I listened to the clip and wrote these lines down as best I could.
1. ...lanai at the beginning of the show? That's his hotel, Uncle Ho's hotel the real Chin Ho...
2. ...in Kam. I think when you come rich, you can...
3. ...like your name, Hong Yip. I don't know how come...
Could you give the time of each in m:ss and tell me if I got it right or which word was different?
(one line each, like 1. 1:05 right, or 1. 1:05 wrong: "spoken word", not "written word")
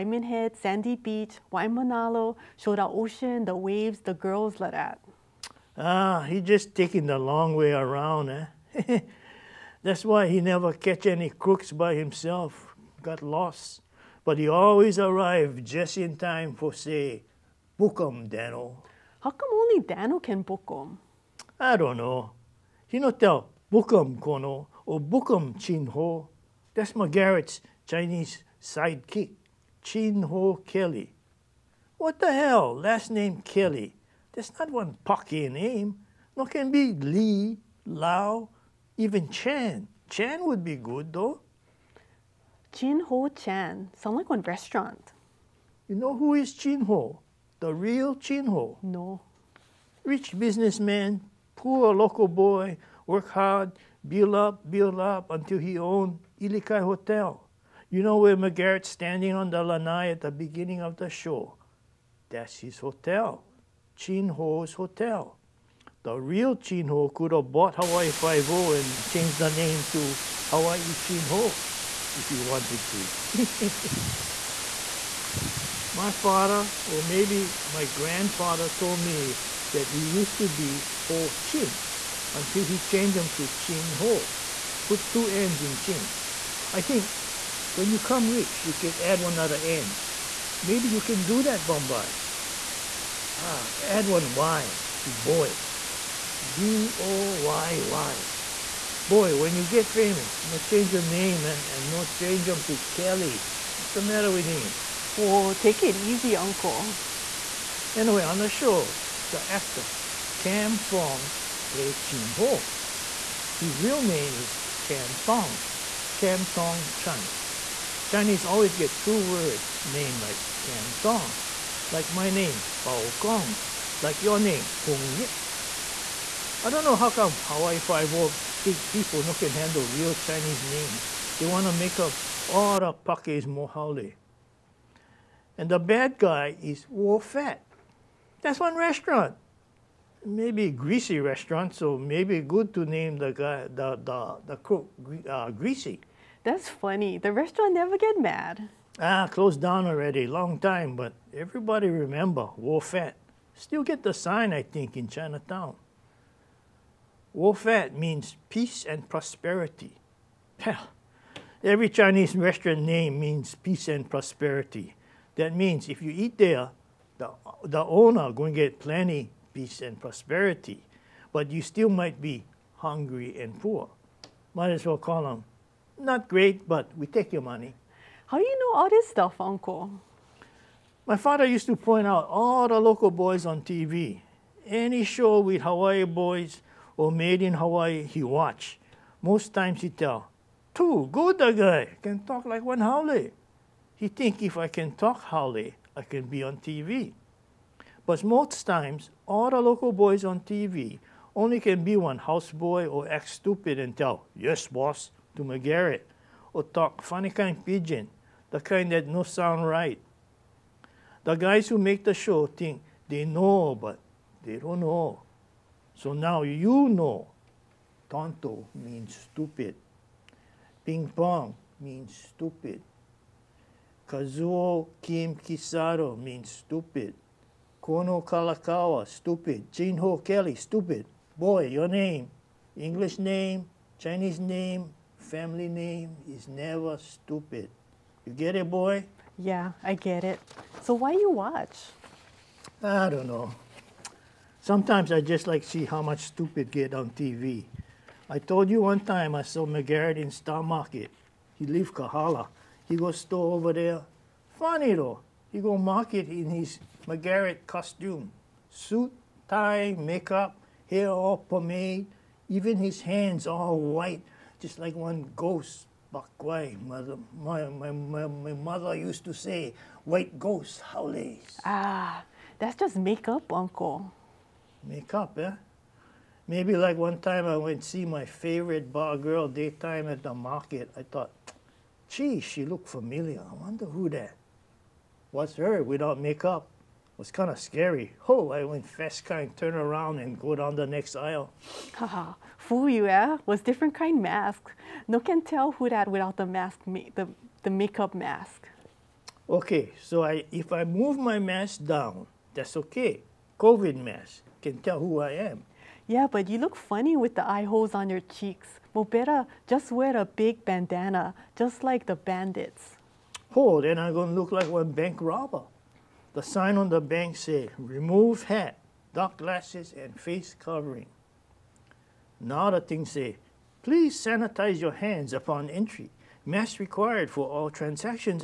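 1. 0:59 wrong: "Chin", not "Uncle"
2. 1:25 wrong: "Chin", not "Kam"
3. 2:04 right.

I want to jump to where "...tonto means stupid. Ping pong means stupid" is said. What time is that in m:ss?
3:38.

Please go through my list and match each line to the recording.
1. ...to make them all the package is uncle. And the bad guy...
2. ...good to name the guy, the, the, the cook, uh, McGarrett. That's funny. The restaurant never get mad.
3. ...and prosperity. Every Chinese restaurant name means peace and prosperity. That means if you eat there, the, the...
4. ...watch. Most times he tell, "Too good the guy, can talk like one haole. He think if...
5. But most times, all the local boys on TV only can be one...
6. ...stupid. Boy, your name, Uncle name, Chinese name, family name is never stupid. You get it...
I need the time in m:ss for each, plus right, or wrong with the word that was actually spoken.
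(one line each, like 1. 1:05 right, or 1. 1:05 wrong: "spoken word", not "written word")
1. 2:11 wrong: "mohale", not "uncle"
2. 2:22 wrong: "Greasy", not "McGarrett"
3. 2:38 right
4. 3:08 right
5. 3:18 right
6. 3:50 wrong: "English", not "Uncle".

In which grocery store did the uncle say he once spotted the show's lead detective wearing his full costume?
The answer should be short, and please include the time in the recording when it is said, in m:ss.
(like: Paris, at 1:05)
Star Market, at 4:10.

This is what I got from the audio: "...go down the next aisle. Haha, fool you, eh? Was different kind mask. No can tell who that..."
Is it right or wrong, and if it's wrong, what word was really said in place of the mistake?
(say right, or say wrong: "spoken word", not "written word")
right.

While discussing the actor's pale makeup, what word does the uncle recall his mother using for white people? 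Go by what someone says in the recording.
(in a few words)
Bakwai.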